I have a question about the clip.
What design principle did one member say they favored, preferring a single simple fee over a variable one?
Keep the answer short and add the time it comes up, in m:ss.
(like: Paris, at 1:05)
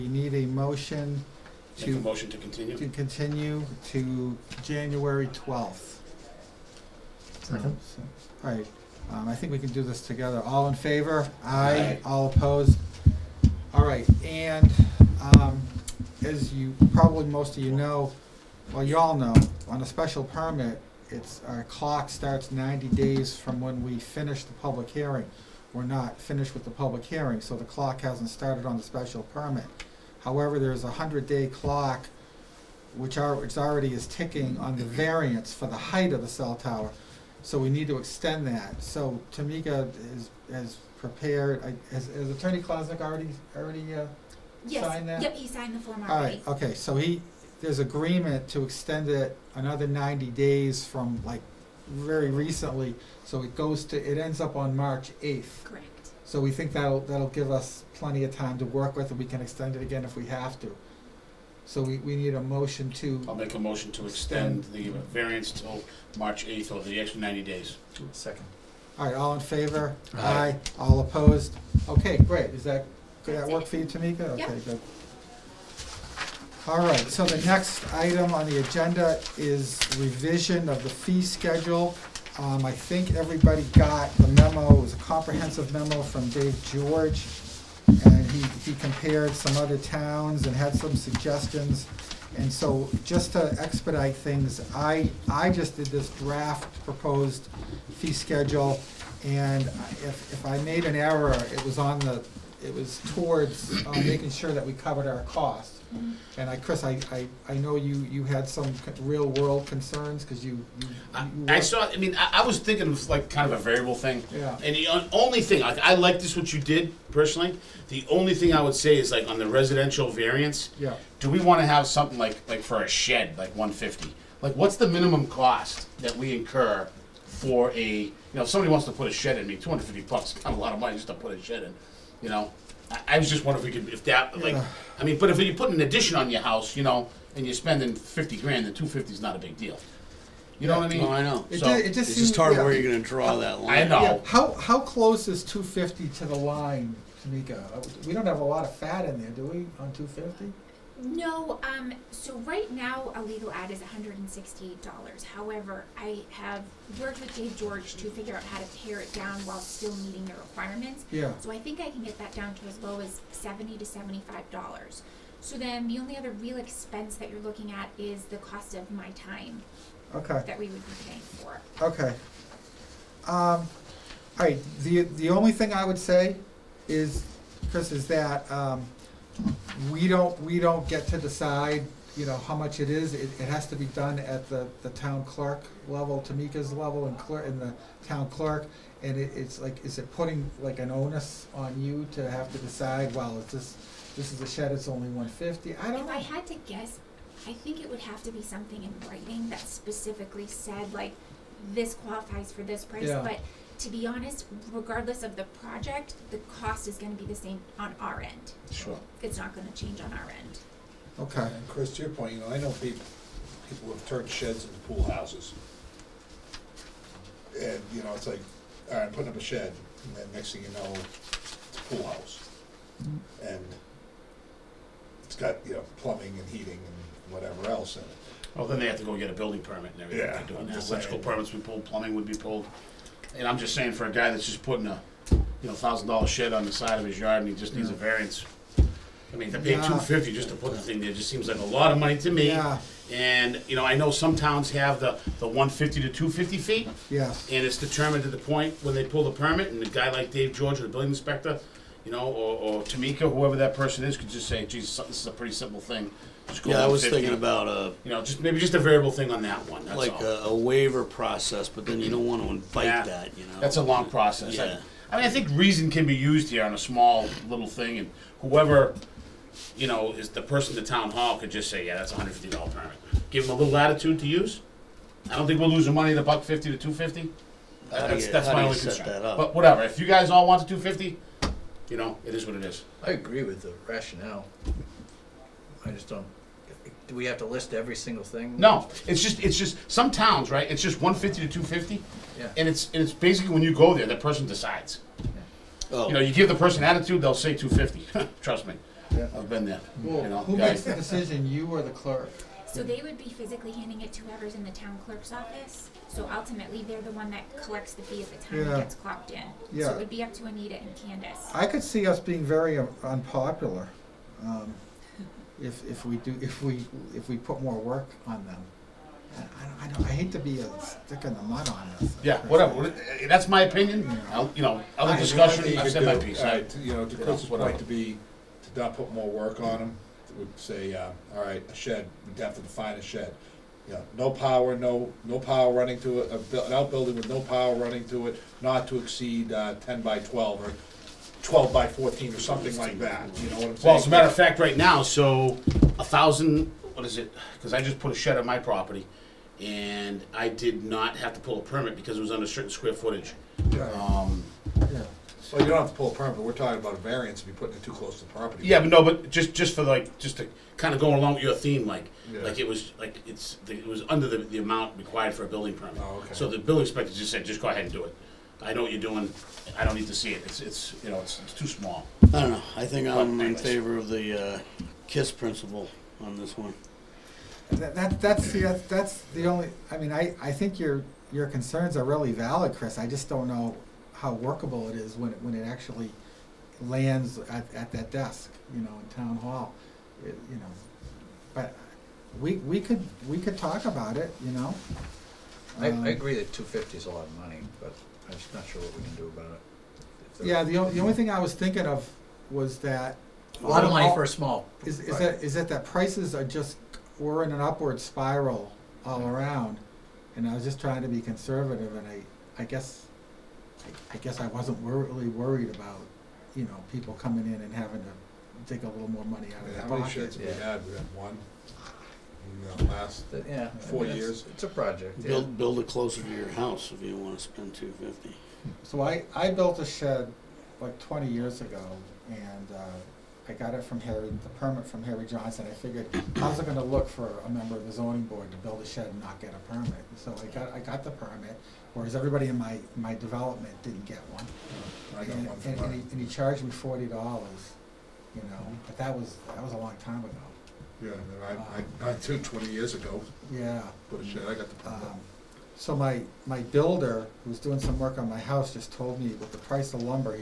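KISS principle, at 6:15.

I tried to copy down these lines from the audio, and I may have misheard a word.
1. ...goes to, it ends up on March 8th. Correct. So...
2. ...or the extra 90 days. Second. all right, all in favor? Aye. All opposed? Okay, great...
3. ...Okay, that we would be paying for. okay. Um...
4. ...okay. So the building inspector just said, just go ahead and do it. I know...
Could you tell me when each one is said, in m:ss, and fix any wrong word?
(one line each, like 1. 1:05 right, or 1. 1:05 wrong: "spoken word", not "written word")
1. 0:53 right
2. 1:06 right
3. 2:50 right
4. 6:06 right.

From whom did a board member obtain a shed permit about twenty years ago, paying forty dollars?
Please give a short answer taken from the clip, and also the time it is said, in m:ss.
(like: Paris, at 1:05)
Harry Johnson, at 7:15.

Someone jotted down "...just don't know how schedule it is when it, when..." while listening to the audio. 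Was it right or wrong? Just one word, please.
wrong.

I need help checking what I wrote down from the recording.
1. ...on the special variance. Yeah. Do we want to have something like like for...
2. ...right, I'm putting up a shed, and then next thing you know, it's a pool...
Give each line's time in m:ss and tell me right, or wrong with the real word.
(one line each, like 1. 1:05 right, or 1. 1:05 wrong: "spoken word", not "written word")
1. 1:59 wrong: "residential", not "special"
2. 3:38 right.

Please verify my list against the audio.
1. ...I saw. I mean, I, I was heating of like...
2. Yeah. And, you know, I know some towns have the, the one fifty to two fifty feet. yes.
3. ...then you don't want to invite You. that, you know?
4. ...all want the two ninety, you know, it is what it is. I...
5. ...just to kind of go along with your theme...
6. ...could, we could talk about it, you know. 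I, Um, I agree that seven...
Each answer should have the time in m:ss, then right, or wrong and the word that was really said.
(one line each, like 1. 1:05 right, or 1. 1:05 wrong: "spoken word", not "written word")
1. 1:51 wrong: "thinking", not "heating"
2. 4:02 right
3. 4:21 wrong: "Yeah", not "You"
4. 4:40 wrong: "fifty", not "ninety"
5. 6:00 right
6. 6:32 wrong: "two", not "seven".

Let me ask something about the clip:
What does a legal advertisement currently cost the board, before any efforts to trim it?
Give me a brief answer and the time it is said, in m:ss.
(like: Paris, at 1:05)
$168, at 2:33.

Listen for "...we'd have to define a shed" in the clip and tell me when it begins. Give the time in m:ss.
5:32.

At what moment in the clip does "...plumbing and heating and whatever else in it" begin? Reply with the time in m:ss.
3:45.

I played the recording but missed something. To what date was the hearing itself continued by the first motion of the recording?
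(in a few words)
January 12.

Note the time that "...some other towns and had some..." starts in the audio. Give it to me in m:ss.
1:29.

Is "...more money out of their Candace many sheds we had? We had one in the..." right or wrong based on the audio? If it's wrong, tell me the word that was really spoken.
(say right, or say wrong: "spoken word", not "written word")
wrong: "How", not "Candace".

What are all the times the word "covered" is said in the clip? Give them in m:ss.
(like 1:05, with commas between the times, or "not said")
1:44.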